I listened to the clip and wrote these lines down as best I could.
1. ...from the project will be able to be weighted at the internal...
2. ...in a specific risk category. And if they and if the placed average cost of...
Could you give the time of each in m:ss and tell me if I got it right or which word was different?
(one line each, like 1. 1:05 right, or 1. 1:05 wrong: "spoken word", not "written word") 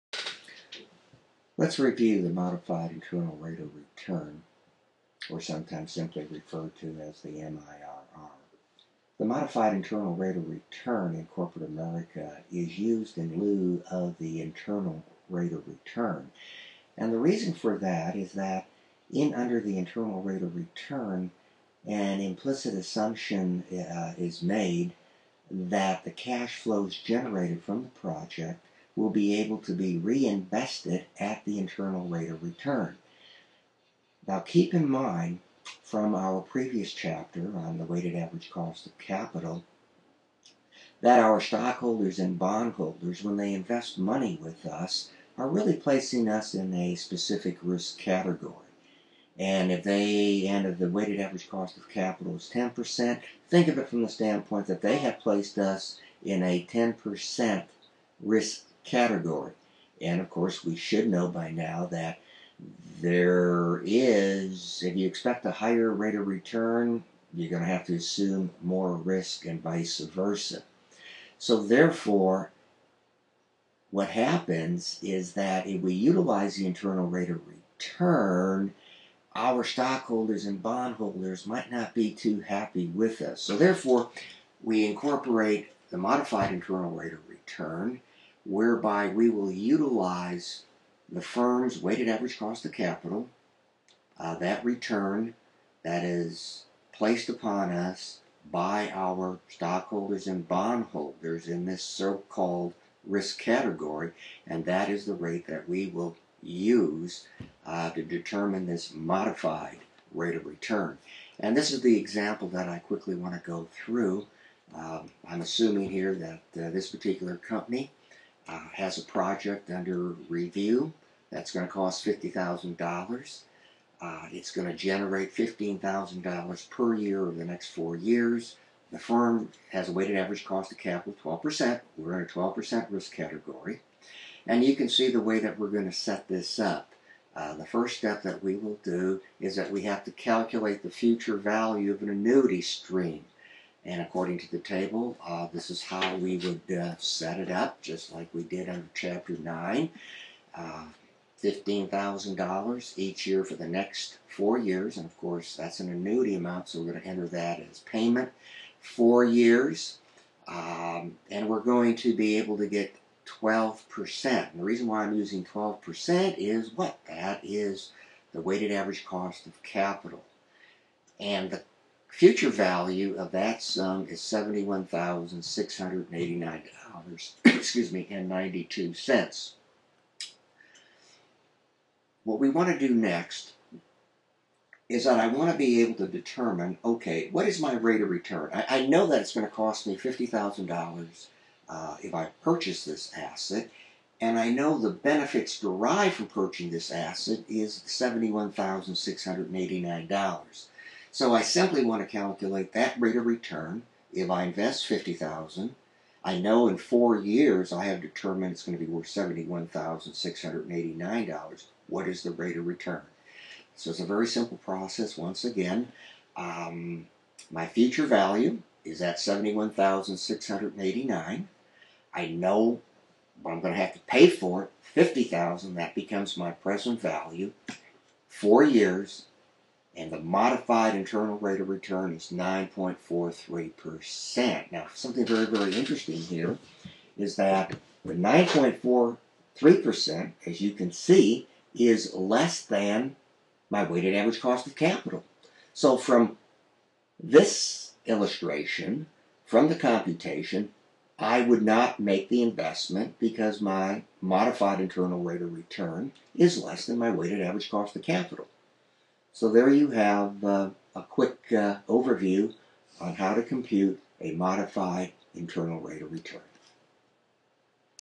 1. 0:27 wrong: "reinvested", not "weighted"
2. 0:46 wrong: "weighted", not "placed".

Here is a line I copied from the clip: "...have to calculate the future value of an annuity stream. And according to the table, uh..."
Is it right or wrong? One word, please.
right.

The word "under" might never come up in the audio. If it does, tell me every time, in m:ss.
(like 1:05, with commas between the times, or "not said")
0:19, 1:59, 2:28.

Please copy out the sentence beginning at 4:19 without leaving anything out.
So there you have uh, a quick uh, overview on how to compute a modified internal rate of return.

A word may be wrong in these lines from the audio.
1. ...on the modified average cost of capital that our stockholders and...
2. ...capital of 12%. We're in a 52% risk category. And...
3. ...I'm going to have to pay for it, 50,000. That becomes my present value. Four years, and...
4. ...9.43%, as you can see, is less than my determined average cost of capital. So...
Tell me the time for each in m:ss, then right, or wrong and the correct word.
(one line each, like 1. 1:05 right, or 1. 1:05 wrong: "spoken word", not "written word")
1. 0:37 wrong: "weighted", not "modified"
2. 2:10 wrong: "12", not "52"
3. 3:43 right
4. 3:58 wrong: "weighted", not "determined".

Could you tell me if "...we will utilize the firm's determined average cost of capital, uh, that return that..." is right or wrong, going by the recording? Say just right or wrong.
wrong.